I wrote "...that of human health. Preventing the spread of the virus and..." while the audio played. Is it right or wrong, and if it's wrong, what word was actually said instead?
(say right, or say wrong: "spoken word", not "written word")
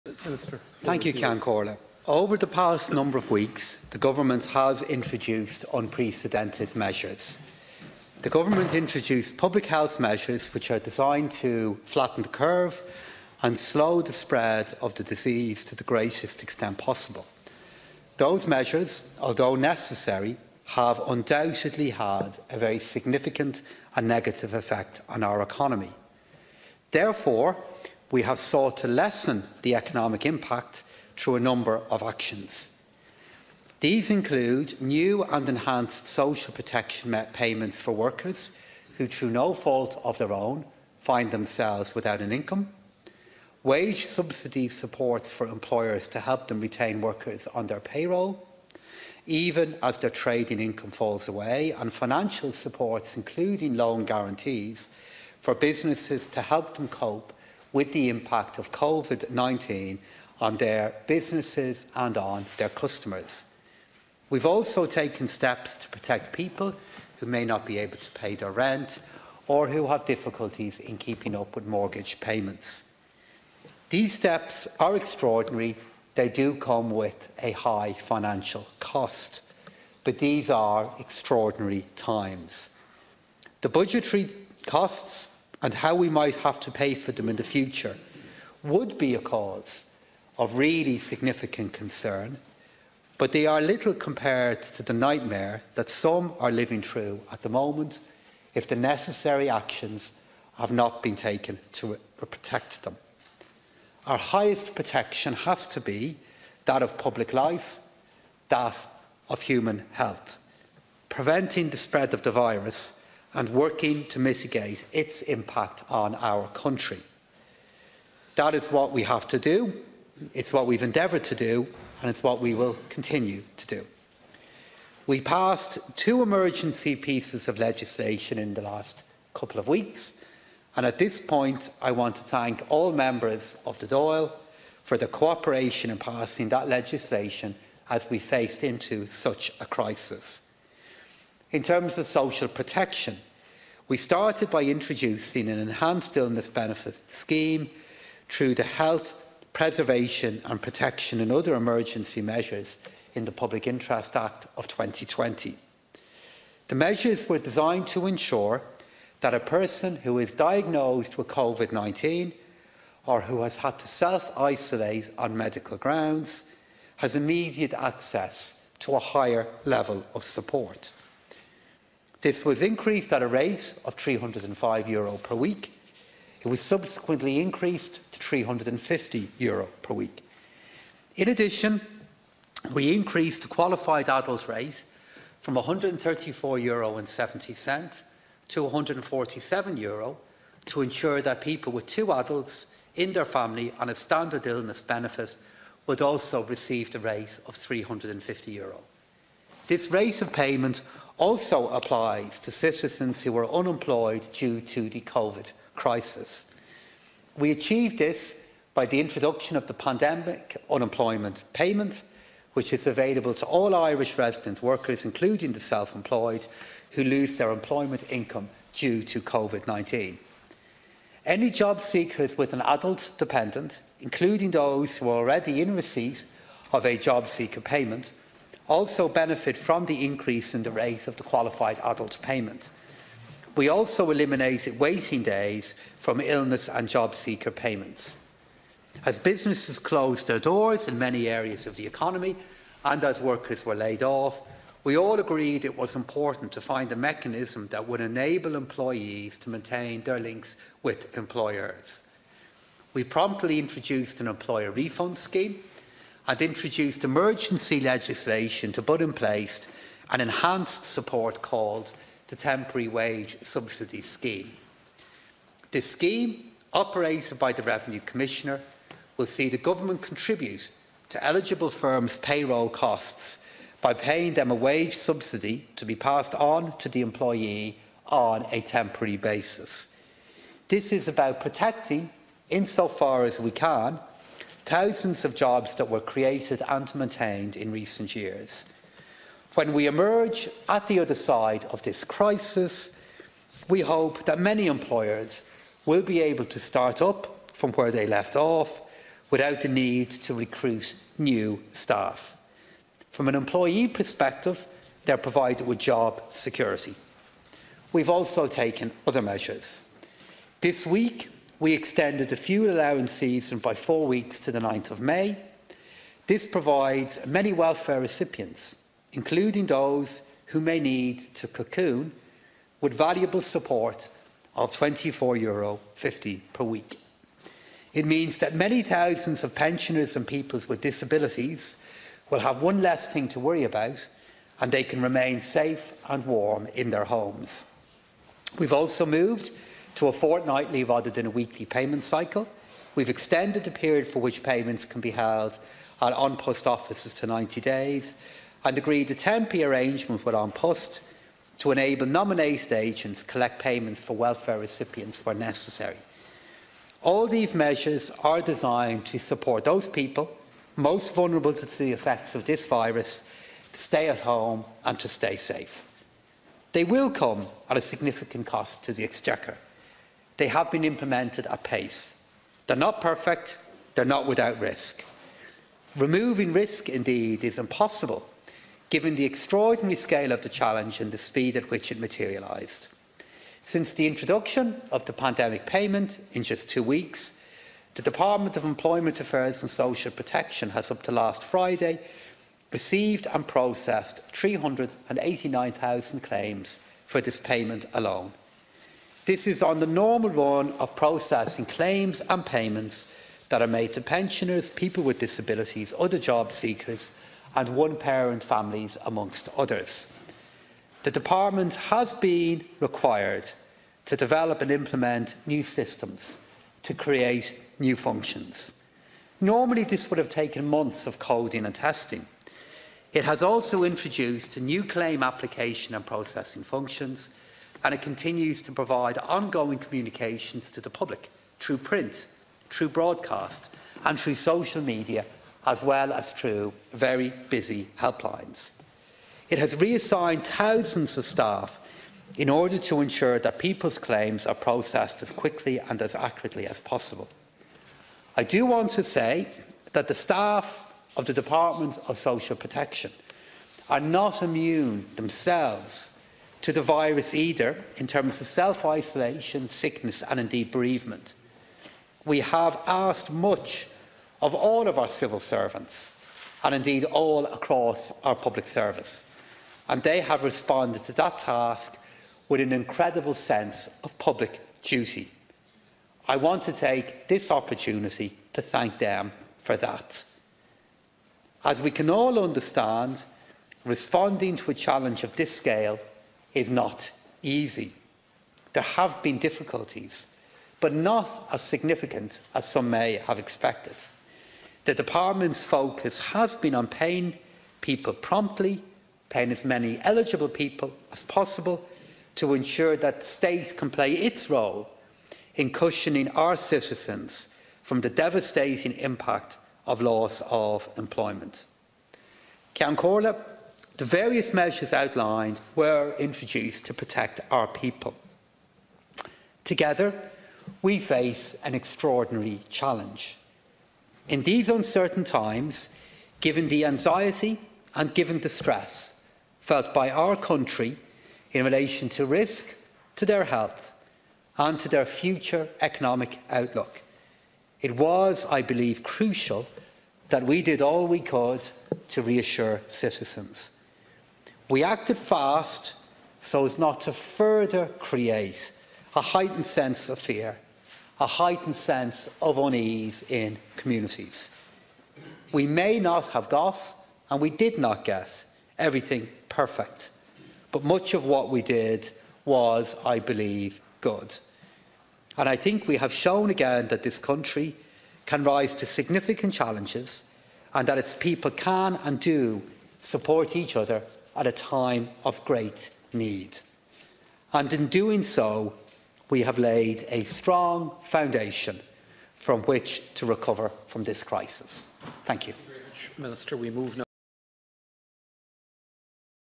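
right.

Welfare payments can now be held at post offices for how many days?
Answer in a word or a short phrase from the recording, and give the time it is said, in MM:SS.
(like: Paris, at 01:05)
90 days, at 05:47.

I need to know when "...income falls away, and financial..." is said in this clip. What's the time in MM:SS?
00:50.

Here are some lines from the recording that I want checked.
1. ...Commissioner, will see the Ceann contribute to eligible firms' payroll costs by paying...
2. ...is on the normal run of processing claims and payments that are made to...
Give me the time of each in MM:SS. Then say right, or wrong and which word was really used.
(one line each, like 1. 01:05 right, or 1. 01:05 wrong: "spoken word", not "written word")
1. 04:28 wrong: "Government", not "Ceann"
2. 06:39 right.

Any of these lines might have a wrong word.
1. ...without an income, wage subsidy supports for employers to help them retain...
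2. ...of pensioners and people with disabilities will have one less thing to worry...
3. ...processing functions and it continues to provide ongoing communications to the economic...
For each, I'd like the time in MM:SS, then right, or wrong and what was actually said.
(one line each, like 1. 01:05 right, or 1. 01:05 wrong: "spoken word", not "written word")
1. 00:41 right
2. 05:29 right
3. 07:06 wrong: "public", not "economic".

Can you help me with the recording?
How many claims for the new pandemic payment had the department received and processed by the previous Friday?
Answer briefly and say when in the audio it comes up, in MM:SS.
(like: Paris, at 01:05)
389,000, at 06:34.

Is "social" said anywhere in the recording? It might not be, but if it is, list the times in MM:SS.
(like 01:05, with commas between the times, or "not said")
00:36, 02:22, 06:29, 07:14, 07:32.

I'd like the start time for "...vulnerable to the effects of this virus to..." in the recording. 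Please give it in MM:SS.
06:01.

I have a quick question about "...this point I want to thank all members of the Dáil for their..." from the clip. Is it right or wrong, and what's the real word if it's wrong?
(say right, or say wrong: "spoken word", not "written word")
right.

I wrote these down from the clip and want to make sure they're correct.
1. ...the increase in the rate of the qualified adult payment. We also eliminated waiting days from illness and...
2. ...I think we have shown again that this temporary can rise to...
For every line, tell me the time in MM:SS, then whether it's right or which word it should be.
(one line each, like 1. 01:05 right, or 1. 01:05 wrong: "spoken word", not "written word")
1. 03:49 right
2. 09:25 wrong: "country", not "temporary".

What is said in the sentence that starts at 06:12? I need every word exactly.
They're not perfect, they're not without risk.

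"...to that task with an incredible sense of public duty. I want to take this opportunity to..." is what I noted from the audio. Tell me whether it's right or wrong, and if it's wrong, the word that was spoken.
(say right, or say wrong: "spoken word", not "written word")
right.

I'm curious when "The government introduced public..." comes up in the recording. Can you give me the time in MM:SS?
00:08.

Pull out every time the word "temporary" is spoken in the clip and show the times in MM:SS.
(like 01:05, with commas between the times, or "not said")
04:22, 04:38, 05:49.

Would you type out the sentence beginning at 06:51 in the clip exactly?
The Department has been required to develop and implement new systems to create new functions.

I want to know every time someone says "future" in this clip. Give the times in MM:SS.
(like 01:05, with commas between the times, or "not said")
01:27, 08:55.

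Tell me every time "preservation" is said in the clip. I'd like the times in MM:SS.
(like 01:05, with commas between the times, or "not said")
02:29.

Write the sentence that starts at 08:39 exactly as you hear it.
Together, we face an extraordinary challenge.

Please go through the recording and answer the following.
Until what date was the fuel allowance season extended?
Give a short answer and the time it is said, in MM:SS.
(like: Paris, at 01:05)
9th of May, at 05:14.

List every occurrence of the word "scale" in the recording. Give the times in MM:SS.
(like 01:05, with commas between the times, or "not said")
06:19, 08:05.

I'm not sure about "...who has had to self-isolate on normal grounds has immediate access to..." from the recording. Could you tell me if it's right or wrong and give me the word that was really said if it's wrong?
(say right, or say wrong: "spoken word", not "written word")
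wrong: "medical", not "normal".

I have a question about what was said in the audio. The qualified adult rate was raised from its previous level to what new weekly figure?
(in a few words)
€147.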